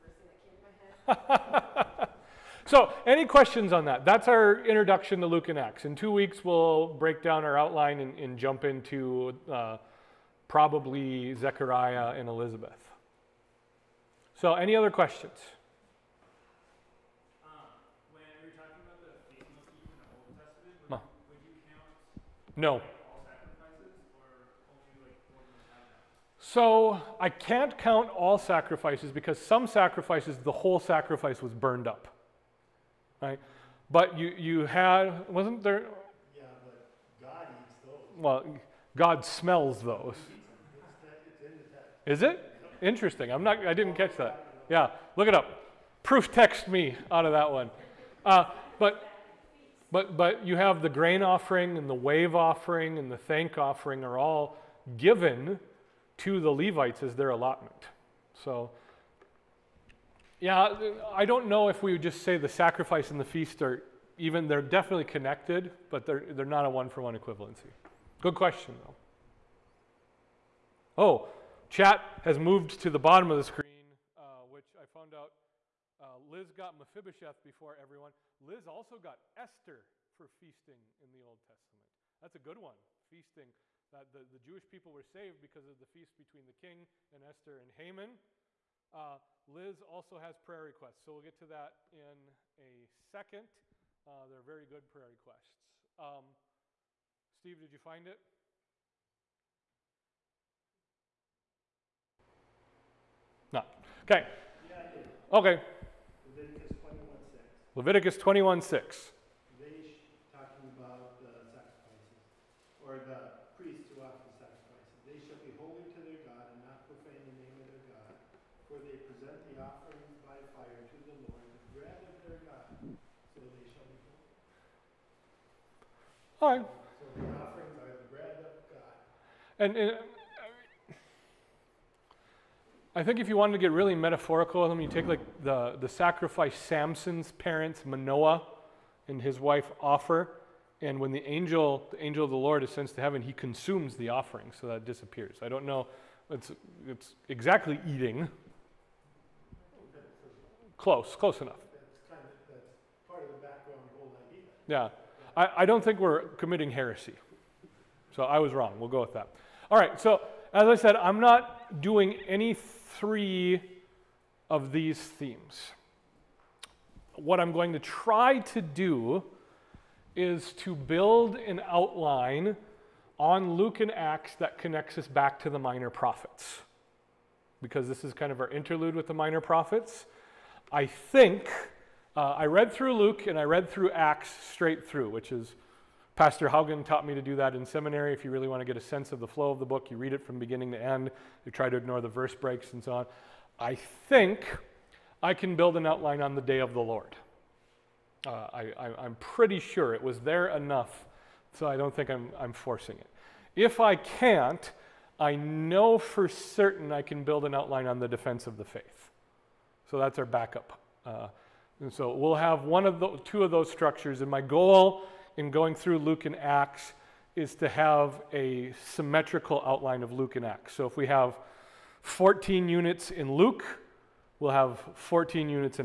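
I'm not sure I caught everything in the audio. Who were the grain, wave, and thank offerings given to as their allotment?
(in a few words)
The Levites.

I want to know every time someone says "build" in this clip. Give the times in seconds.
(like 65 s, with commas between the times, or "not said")
170 s, 195 s, 207 s.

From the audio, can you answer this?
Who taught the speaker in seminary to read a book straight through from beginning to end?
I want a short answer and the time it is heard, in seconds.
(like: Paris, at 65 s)
Pastor Haugen, at 186 s.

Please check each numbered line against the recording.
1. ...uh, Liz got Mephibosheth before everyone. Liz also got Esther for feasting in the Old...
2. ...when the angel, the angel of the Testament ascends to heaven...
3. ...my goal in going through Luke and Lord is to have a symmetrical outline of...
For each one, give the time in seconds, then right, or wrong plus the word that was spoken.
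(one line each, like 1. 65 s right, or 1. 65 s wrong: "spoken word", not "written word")
1. 75 s right
2. 140 s wrong: "Lord", not "Testament"
3. 214 s wrong: "Acts", not "Lord".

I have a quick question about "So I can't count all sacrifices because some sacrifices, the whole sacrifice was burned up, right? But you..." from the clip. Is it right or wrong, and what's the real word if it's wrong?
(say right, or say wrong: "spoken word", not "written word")
right.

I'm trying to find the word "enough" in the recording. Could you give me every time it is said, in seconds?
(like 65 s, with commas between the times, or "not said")
151 s, 200 s.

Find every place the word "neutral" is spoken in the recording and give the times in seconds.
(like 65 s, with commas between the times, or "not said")
not said.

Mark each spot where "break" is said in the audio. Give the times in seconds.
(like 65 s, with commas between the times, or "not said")
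6 s, 192 s.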